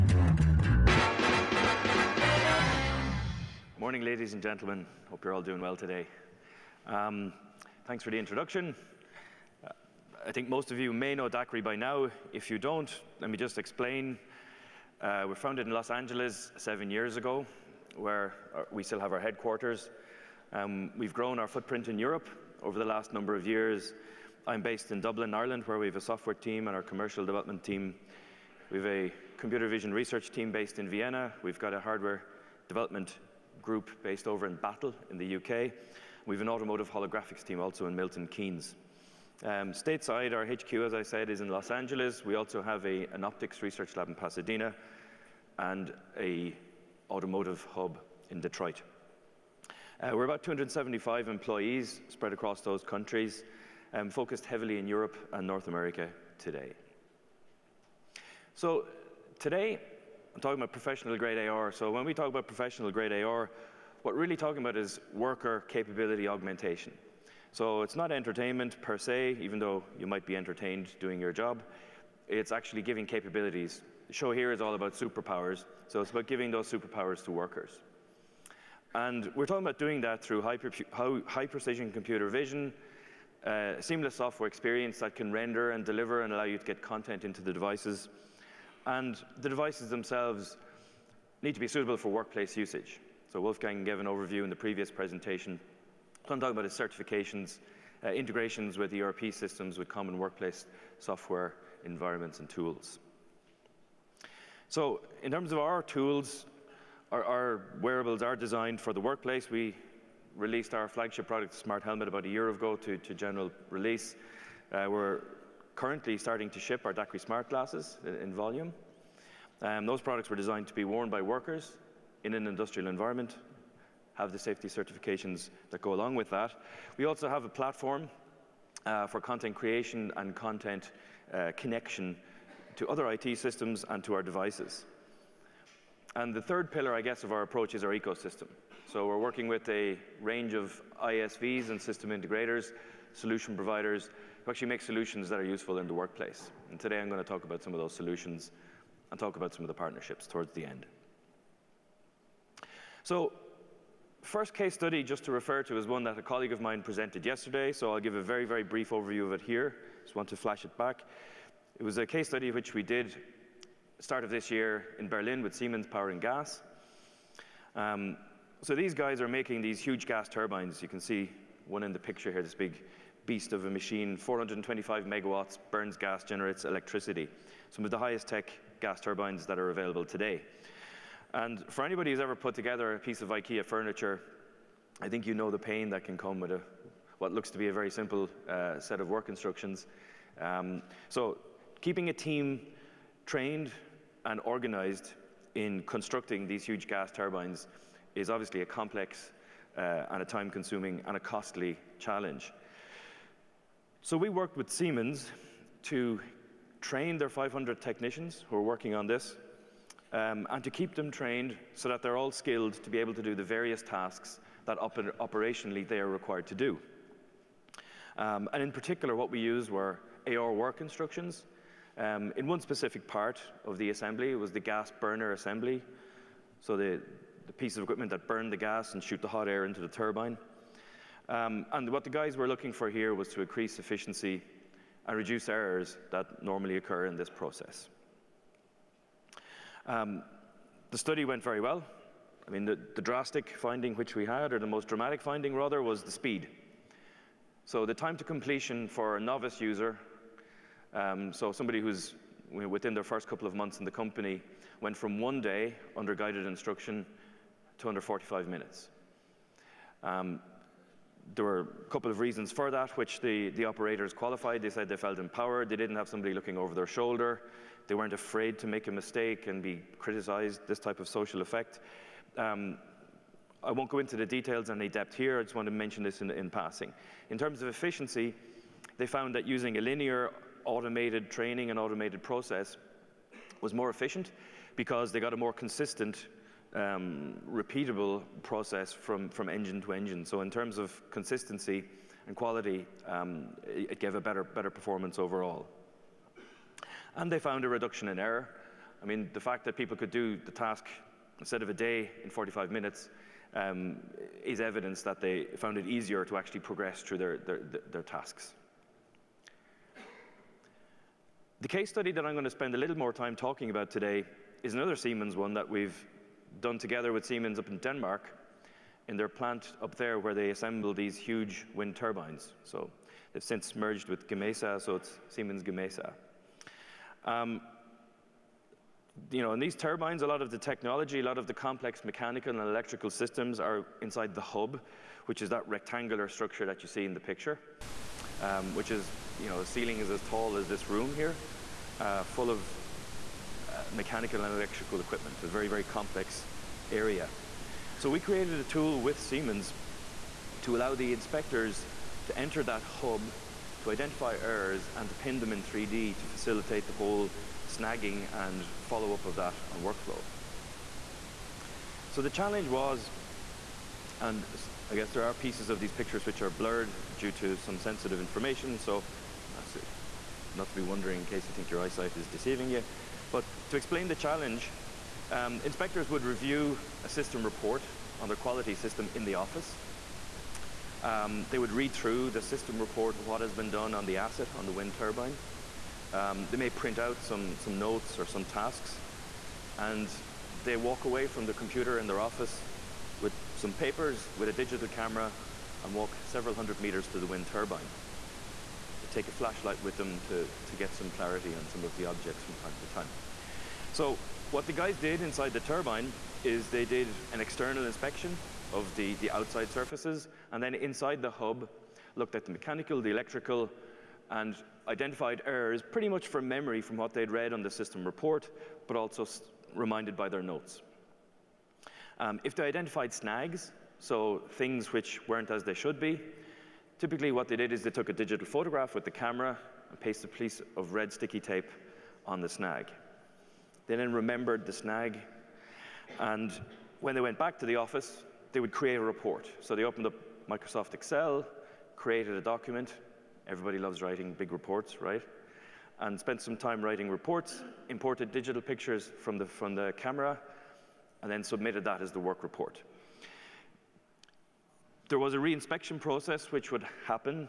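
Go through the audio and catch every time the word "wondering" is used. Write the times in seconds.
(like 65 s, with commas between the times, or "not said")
370 s.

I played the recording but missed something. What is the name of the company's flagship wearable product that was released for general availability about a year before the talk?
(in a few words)
Smart Helmet.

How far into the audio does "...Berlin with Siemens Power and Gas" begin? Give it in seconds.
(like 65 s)
165 s.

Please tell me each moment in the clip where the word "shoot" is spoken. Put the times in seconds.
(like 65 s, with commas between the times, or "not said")
229 s.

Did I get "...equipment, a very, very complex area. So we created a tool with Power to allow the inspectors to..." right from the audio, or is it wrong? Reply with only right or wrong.
wrong.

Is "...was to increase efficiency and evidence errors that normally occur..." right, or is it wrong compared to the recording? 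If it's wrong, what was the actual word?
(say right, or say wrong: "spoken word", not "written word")
wrong: "reduce", not "evidence".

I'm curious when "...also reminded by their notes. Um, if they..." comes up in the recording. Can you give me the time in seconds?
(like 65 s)
418 s.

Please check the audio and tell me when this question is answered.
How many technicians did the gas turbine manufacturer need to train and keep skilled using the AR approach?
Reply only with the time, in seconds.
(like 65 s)
207 s.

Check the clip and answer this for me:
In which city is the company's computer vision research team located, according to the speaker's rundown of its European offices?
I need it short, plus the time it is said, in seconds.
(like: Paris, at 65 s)
Vienna, at 30 s.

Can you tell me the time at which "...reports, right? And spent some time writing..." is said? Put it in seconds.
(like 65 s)
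444 s.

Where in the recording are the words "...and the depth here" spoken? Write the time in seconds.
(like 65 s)
274 s.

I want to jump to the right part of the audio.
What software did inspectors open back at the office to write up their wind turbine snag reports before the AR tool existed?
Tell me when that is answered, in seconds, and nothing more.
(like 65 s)
440 s.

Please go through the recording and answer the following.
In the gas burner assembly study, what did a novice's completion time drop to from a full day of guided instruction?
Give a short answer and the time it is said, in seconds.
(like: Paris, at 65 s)
under 45 minutes, at 257 s.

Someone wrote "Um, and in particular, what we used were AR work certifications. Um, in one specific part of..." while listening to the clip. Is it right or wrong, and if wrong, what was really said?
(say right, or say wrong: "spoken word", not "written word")
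wrong: "instructions", not "certifications".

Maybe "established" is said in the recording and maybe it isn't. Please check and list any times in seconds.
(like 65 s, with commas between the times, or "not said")
not said.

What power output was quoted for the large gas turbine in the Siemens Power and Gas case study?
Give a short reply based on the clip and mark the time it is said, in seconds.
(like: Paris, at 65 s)
425 megawatts, at 174 s.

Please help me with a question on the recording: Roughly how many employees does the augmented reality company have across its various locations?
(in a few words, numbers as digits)
275.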